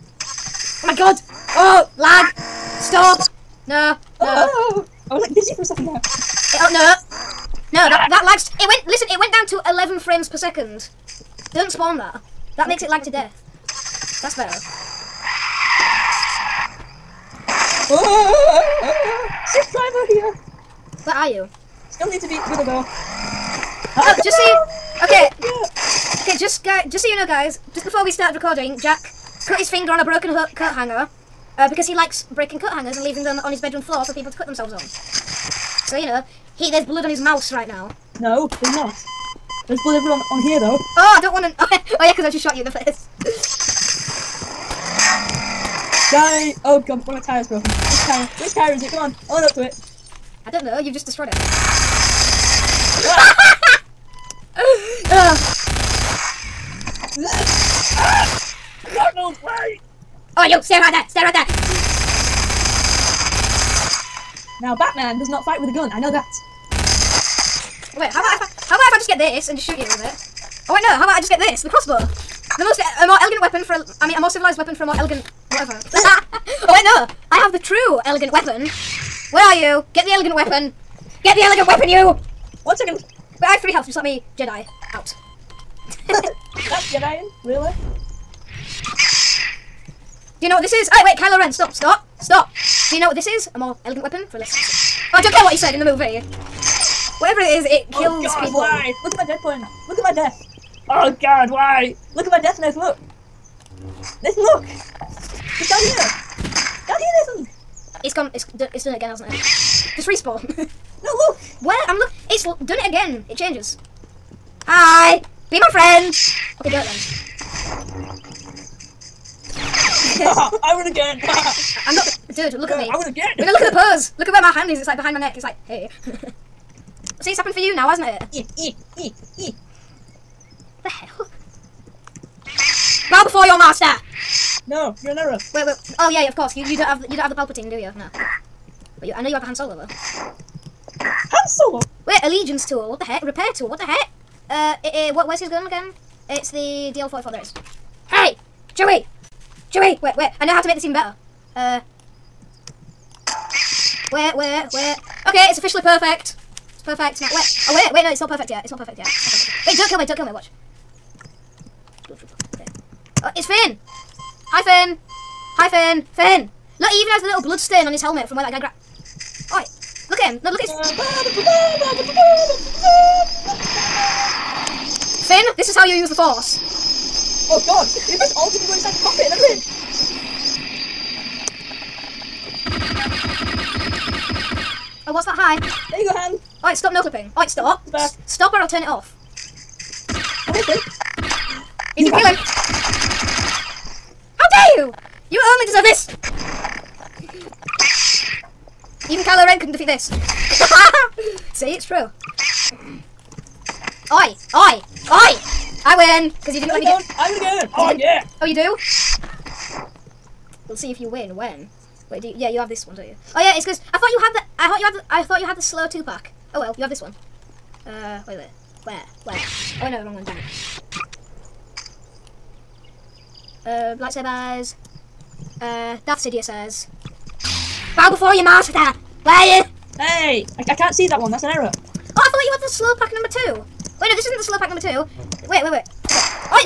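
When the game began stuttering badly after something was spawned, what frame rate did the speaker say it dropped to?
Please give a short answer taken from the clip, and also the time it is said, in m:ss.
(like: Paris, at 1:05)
11 frames per second, at 0:09.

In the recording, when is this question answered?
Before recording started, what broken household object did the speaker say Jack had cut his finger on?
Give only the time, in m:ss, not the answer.
0:30.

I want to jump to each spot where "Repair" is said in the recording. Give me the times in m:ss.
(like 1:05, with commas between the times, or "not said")
2:23.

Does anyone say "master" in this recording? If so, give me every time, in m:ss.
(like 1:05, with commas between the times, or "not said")
2:13, 3:48.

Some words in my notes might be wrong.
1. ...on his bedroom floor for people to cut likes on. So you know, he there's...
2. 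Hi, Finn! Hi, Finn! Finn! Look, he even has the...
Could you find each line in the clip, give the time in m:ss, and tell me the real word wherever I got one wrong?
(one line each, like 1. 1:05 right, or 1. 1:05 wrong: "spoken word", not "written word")
1. 0:33 wrong: "themselves", not "likes"
2. 2:44 right.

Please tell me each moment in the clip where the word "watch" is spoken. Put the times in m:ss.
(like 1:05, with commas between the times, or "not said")
2:40.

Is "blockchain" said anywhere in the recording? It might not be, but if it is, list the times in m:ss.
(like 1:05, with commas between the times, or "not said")
not said.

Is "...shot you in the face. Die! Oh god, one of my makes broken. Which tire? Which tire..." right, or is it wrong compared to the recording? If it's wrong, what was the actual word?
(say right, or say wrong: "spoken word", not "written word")
wrong: "tires", not "makes".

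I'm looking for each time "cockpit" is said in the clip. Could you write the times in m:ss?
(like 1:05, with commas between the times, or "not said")
2:59.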